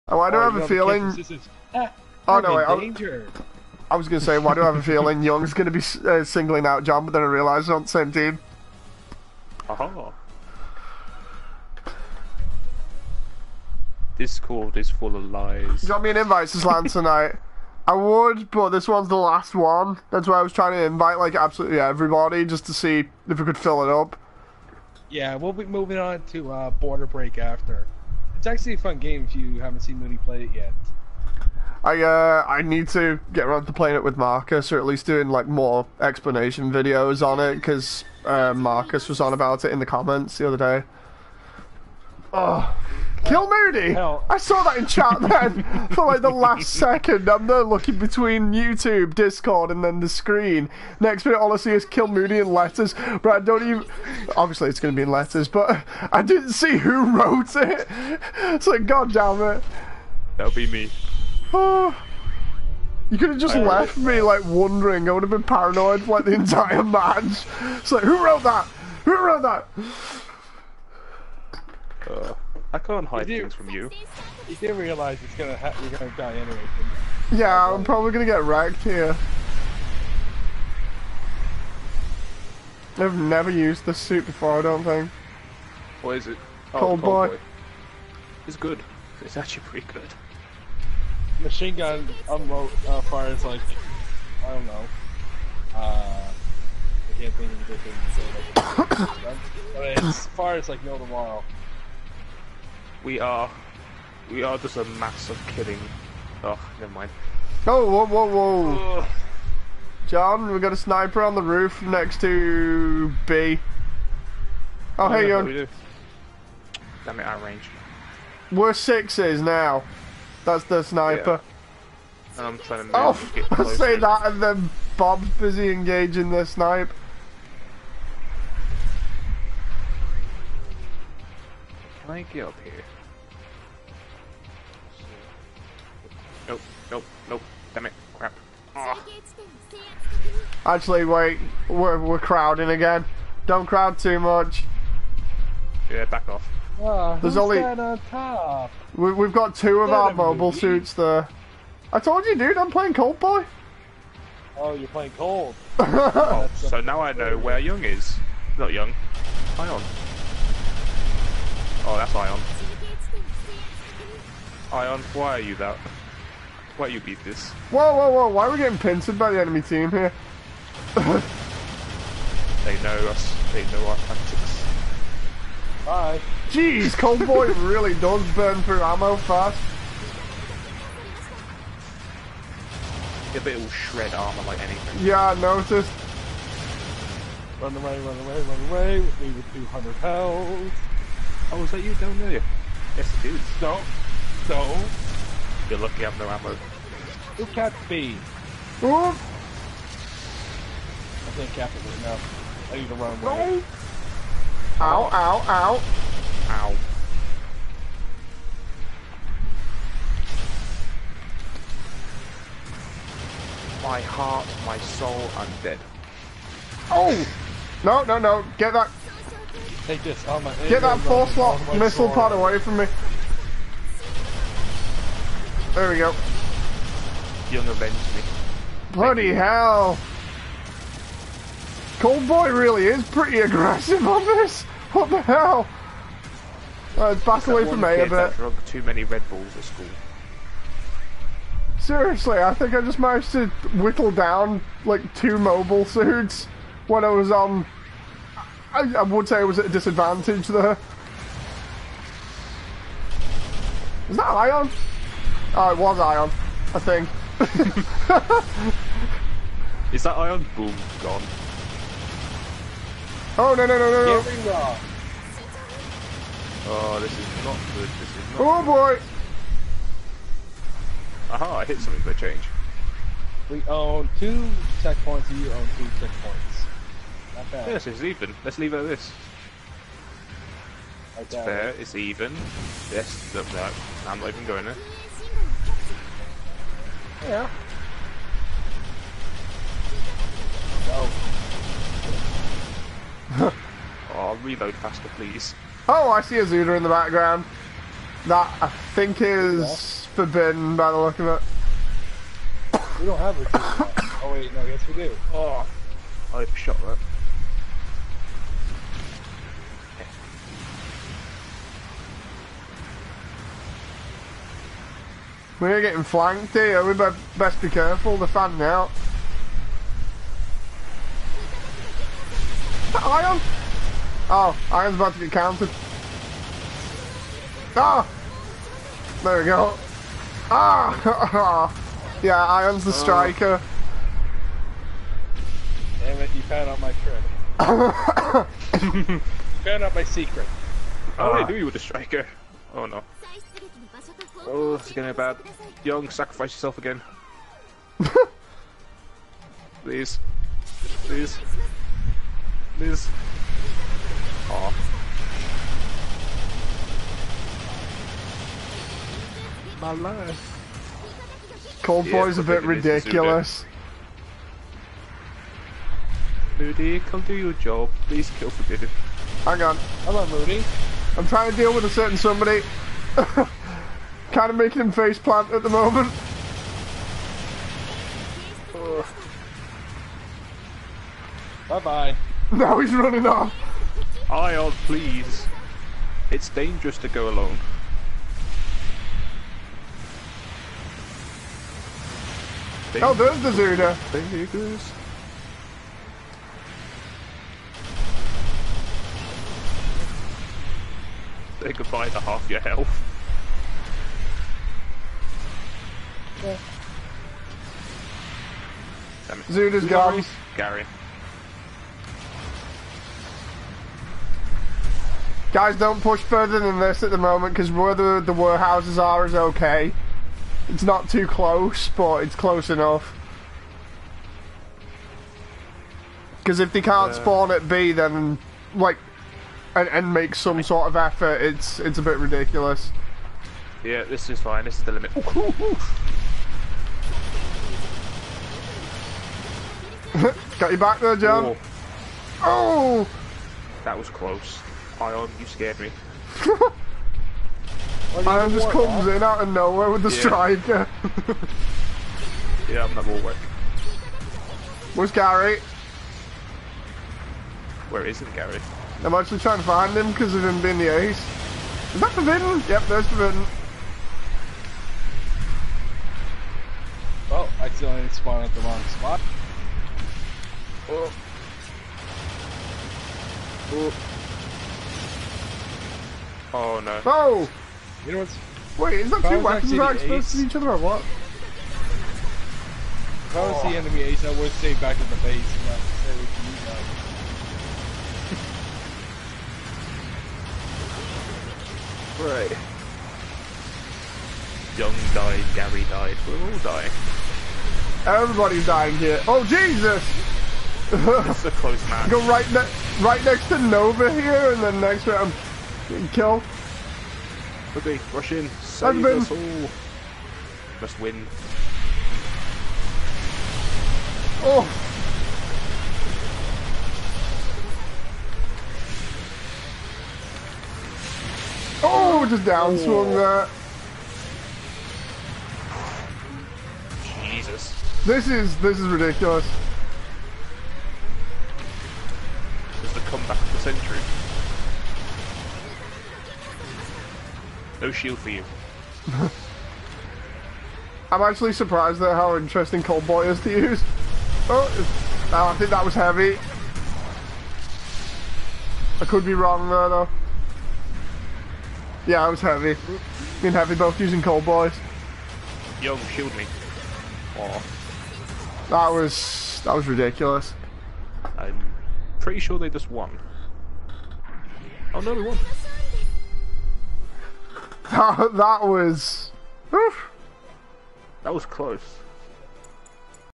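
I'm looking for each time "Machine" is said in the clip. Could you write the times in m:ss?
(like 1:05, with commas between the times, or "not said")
1:31.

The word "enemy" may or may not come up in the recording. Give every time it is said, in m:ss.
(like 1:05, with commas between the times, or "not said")
2:49, 8:03.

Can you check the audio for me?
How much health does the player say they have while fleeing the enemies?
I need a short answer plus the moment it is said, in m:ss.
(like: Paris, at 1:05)
200, at 3:09.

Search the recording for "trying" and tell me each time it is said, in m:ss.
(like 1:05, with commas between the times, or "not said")
0:20, 2:02, 6:11, 7:39.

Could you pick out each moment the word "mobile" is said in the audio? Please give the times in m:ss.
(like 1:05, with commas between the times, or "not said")
2:30, 4:05.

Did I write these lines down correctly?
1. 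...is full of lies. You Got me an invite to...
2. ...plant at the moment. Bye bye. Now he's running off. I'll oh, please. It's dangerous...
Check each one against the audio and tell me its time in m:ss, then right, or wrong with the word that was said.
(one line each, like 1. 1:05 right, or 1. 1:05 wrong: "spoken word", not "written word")
1. 0:14 right
2. 6:15 right.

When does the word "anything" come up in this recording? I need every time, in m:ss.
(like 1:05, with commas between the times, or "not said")
1:37, 3:04.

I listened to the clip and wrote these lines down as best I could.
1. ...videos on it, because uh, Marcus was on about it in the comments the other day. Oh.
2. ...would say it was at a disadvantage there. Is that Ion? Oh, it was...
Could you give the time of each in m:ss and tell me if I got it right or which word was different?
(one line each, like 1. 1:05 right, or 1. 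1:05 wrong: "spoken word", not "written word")
1. 0:36 right
2. 4:09 right.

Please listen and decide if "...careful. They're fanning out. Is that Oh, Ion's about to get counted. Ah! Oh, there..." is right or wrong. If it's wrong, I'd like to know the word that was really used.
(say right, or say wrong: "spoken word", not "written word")
right.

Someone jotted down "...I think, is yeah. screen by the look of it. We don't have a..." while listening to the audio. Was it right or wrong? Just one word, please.
wrong.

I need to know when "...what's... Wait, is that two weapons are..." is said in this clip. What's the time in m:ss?
7:58.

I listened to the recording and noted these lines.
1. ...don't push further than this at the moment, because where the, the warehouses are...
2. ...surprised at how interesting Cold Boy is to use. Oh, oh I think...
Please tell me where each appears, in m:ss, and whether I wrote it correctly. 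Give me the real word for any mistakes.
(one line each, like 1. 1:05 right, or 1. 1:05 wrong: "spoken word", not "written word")
1. 6:55 right
2. 9:01 right.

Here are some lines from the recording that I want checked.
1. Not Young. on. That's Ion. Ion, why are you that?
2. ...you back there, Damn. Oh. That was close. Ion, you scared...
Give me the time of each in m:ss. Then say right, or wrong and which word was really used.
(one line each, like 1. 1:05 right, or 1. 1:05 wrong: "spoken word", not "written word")
1. 2:38 right
2. 7:20 wrong: "John", not "Damn".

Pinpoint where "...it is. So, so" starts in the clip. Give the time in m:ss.
3:13.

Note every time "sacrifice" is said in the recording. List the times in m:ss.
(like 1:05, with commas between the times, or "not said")
5:46.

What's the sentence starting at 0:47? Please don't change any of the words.
I'm there looking between YouTube, Discord, and then the screen.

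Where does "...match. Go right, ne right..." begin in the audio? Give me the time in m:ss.
8:21.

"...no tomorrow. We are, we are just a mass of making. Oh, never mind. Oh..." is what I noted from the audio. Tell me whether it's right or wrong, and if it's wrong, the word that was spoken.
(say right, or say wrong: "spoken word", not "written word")
wrong: "killing", not "making".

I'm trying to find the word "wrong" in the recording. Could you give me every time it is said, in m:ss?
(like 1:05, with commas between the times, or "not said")
3:22, 7:48, 9:09.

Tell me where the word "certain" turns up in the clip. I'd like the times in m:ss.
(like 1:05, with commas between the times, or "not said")
6:11.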